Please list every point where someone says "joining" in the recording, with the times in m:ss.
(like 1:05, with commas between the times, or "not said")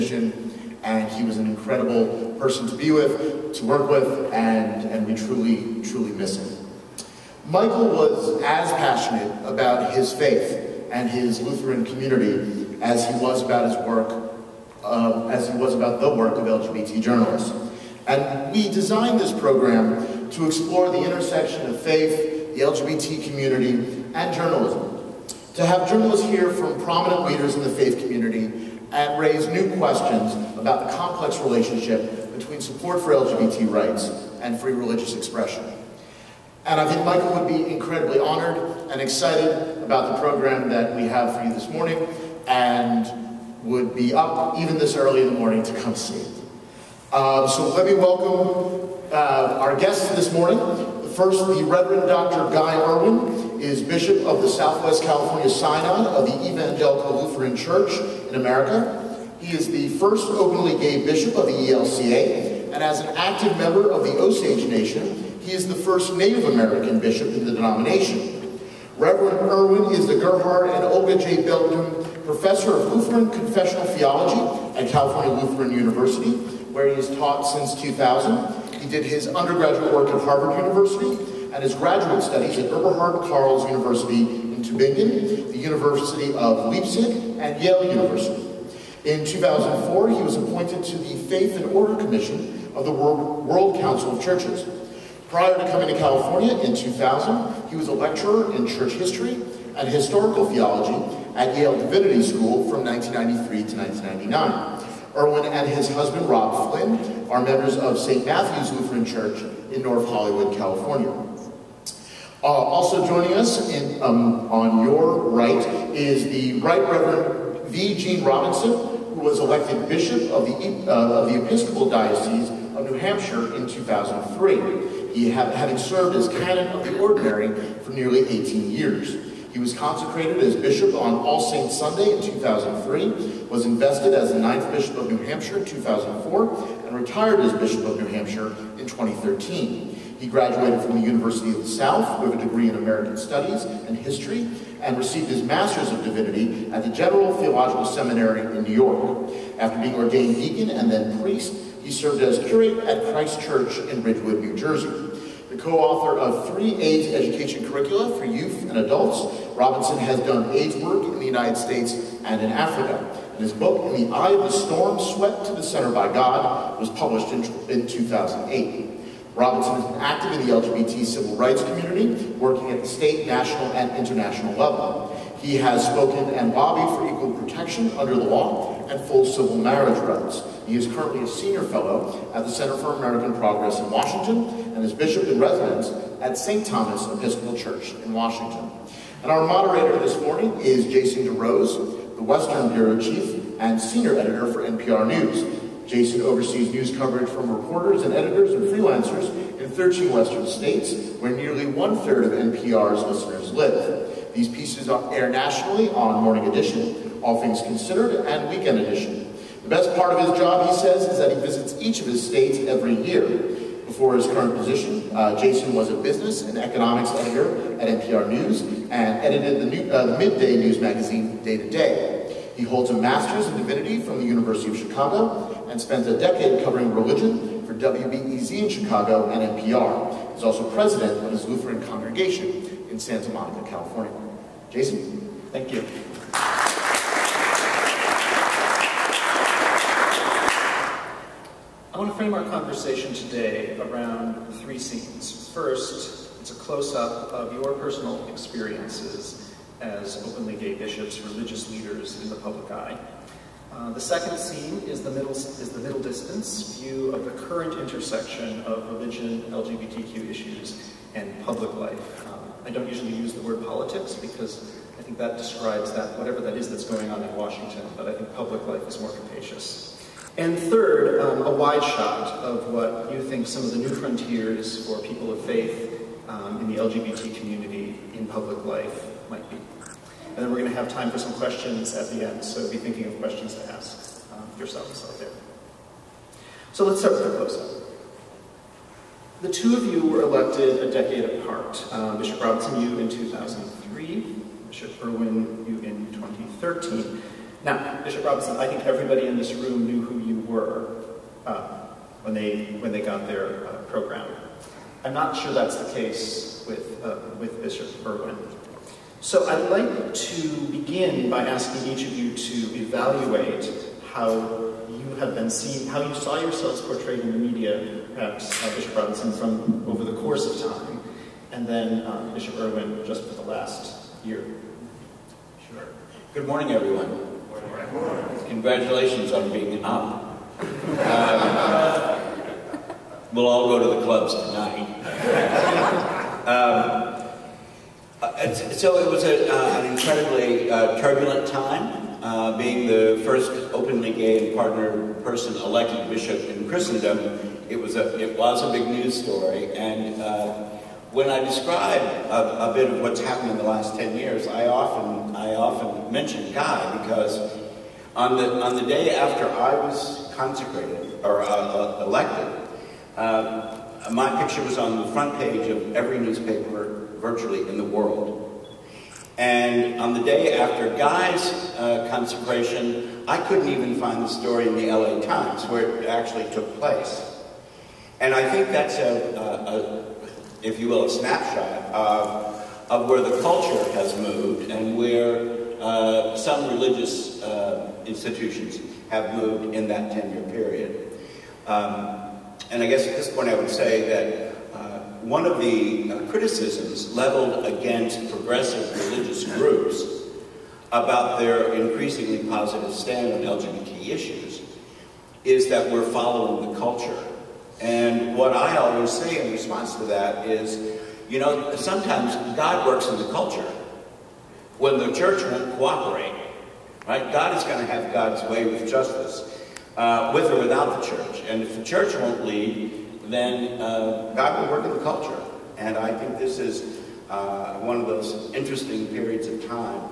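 1:53.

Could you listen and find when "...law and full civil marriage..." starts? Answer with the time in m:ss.
2:58.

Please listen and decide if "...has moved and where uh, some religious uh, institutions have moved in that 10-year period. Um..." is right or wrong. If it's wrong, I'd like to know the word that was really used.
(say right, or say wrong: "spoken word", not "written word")
right.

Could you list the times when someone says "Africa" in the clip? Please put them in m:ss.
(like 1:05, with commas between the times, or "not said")
2:42.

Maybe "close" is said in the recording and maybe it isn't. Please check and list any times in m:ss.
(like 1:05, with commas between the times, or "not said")
4:06, 4:47.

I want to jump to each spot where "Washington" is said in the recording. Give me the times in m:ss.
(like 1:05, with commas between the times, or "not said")
3:03, 3:08, 4:27.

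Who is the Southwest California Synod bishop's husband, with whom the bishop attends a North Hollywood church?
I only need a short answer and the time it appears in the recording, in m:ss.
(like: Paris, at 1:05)
Rob Flynn, at 1:46.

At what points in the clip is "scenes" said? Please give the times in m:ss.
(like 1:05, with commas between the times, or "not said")
4:04, 4:14.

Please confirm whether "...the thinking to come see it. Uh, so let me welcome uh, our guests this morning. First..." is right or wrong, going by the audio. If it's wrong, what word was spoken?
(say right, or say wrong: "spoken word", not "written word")
wrong: "morning", not "thinking".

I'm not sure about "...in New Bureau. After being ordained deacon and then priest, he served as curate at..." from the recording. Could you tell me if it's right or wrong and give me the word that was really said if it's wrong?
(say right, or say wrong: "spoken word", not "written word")
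wrong: "York", not "Bureau".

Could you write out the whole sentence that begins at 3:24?
These pieces air nationally on Morning Edition, All Things Considered, and Weekend Edition.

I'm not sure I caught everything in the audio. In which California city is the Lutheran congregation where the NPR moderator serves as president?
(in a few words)
Santa Monica.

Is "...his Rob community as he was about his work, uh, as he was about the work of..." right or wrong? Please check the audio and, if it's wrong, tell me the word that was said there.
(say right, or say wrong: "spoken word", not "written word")
wrong: "Lutheran", not "Rob".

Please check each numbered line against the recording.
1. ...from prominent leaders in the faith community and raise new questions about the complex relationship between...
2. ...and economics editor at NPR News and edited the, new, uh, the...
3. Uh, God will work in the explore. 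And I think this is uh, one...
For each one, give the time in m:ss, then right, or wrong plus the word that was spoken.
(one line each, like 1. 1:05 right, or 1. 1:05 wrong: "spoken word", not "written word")
1. 0:26 right
2. 3:36 right
3. 7:03 wrong: "culture", not "explore".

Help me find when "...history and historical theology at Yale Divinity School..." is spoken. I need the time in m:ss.
1:38.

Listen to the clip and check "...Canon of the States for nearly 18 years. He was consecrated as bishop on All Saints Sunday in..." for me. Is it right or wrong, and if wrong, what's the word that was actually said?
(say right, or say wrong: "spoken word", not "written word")
wrong: "Ordinary", not "States".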